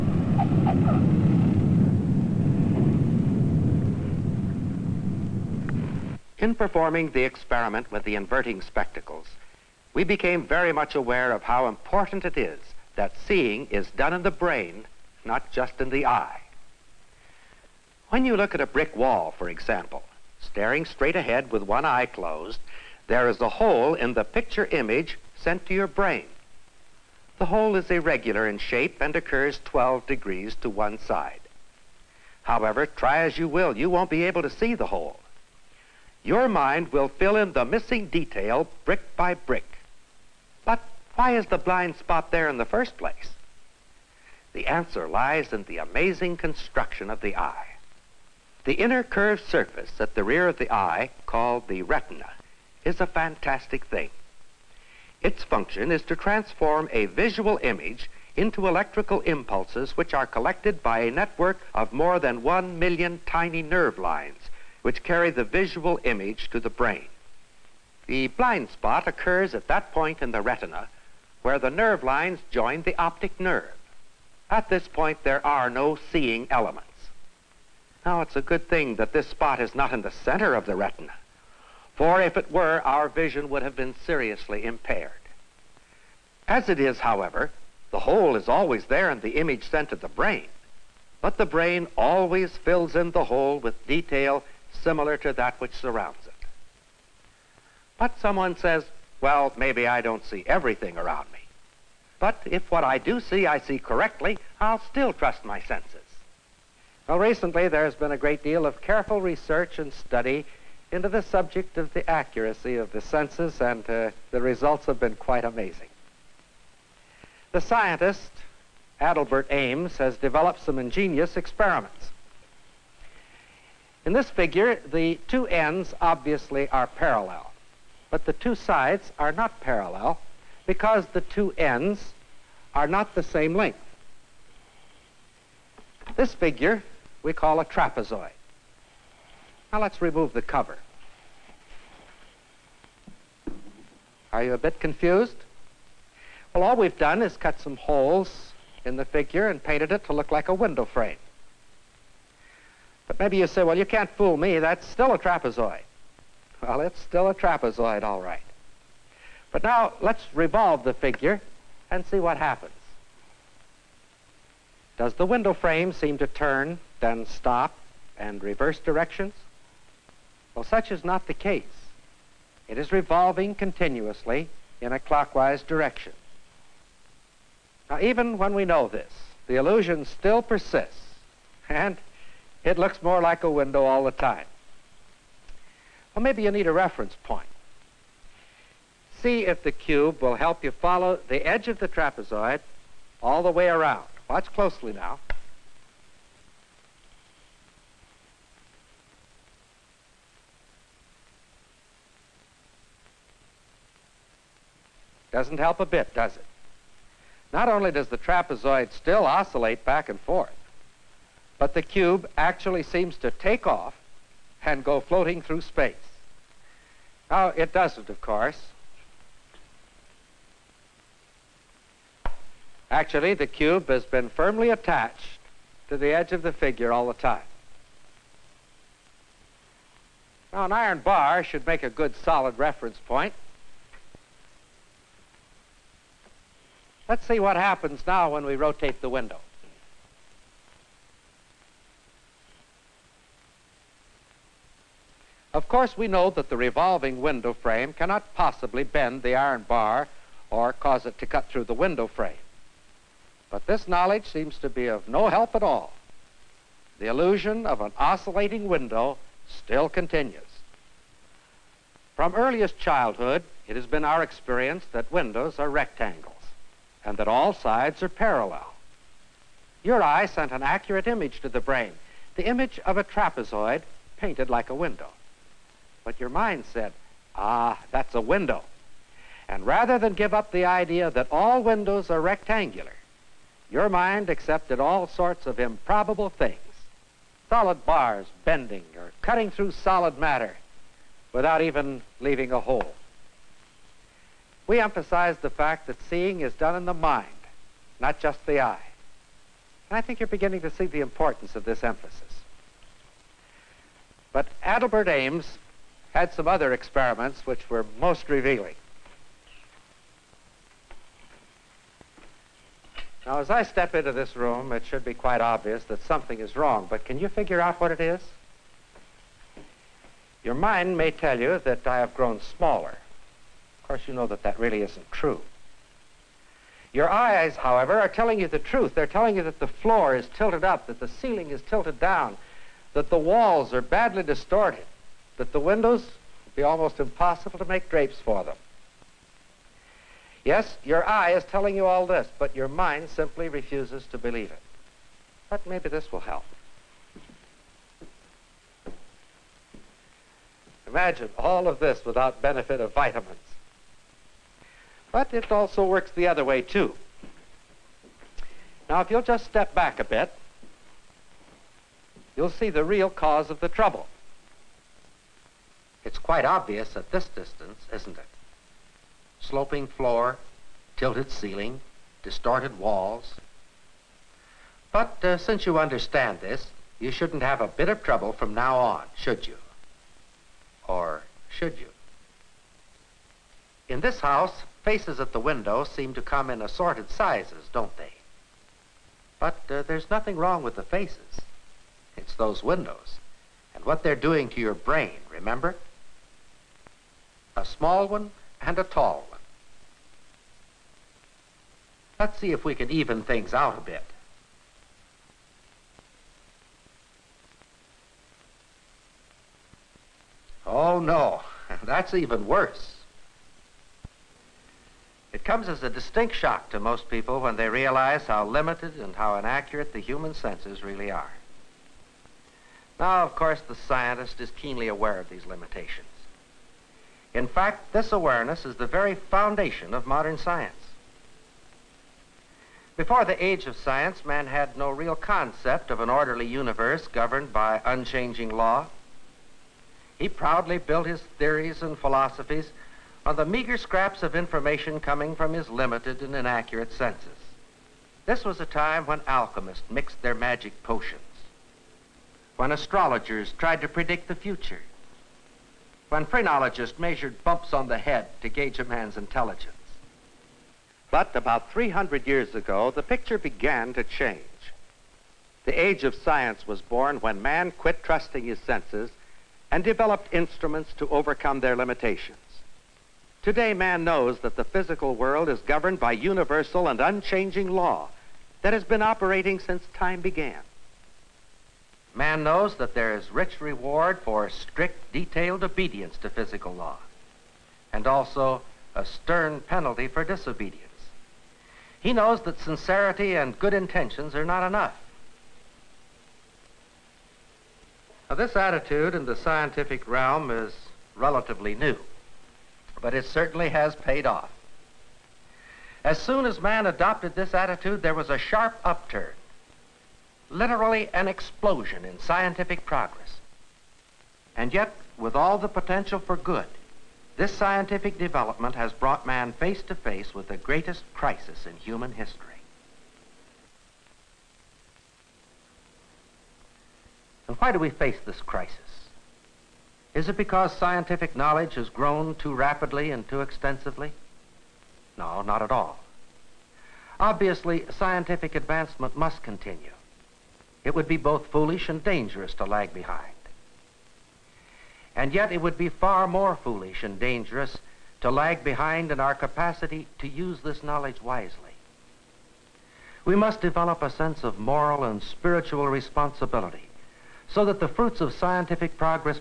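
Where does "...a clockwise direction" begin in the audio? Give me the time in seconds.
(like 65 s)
174 s.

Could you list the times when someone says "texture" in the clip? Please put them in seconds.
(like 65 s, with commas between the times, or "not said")
not said.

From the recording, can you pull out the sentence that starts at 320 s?
Your mind may tell you that I have grown smaller.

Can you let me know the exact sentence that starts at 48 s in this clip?
The inner curved surface at the rear of the eye, called the retina, is a fantastic thing.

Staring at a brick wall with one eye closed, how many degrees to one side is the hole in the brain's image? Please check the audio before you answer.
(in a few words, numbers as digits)
12 degrees.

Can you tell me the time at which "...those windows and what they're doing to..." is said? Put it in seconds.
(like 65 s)
392 s.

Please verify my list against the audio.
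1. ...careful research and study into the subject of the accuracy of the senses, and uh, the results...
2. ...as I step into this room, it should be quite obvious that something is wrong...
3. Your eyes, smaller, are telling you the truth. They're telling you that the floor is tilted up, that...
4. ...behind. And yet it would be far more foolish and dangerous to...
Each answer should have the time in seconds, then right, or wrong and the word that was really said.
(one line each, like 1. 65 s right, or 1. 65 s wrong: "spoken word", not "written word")
1. 108 s right
2. 313 s right
3. 326 s wrong: "however", not "smaller"
4. 542 s right.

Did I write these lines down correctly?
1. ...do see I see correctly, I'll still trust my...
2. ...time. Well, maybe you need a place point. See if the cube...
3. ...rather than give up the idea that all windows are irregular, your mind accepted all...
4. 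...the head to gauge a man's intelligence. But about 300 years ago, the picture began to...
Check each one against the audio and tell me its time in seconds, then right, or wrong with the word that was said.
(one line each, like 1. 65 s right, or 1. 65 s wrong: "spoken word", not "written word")
1. 102 s right
2. 184 s wrong: "reference", not "place"
3. 279 s wrong: "rectangular", not "irregular"
4. 457 s right.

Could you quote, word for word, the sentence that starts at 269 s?
Your eye sent an accurate image to the brain, the image of a trapezoid painted like a window.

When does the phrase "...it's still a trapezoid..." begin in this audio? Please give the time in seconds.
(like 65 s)
156 s.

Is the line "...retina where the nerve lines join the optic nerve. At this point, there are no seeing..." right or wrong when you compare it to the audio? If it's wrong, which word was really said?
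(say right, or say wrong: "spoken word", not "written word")
right.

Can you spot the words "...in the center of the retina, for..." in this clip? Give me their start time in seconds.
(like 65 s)
79 s.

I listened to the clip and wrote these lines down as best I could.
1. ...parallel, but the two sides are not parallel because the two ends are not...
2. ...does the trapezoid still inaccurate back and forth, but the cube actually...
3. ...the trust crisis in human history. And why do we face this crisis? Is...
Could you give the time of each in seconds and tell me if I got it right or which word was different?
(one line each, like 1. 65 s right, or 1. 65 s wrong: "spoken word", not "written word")
1. 126 s right
2. 207 s wrong: "oscillate", not "inaccurate"
3. 520 s wrong: "greatest", not "trust".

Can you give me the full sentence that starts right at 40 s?
But why is the blind spot there in the first place?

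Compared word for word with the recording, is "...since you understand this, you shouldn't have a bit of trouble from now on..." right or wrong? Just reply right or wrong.
right.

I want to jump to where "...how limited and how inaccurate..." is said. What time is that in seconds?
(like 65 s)
418 s.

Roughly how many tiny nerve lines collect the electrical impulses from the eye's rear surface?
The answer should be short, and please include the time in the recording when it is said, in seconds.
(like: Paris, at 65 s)
more than one million, at 61 s.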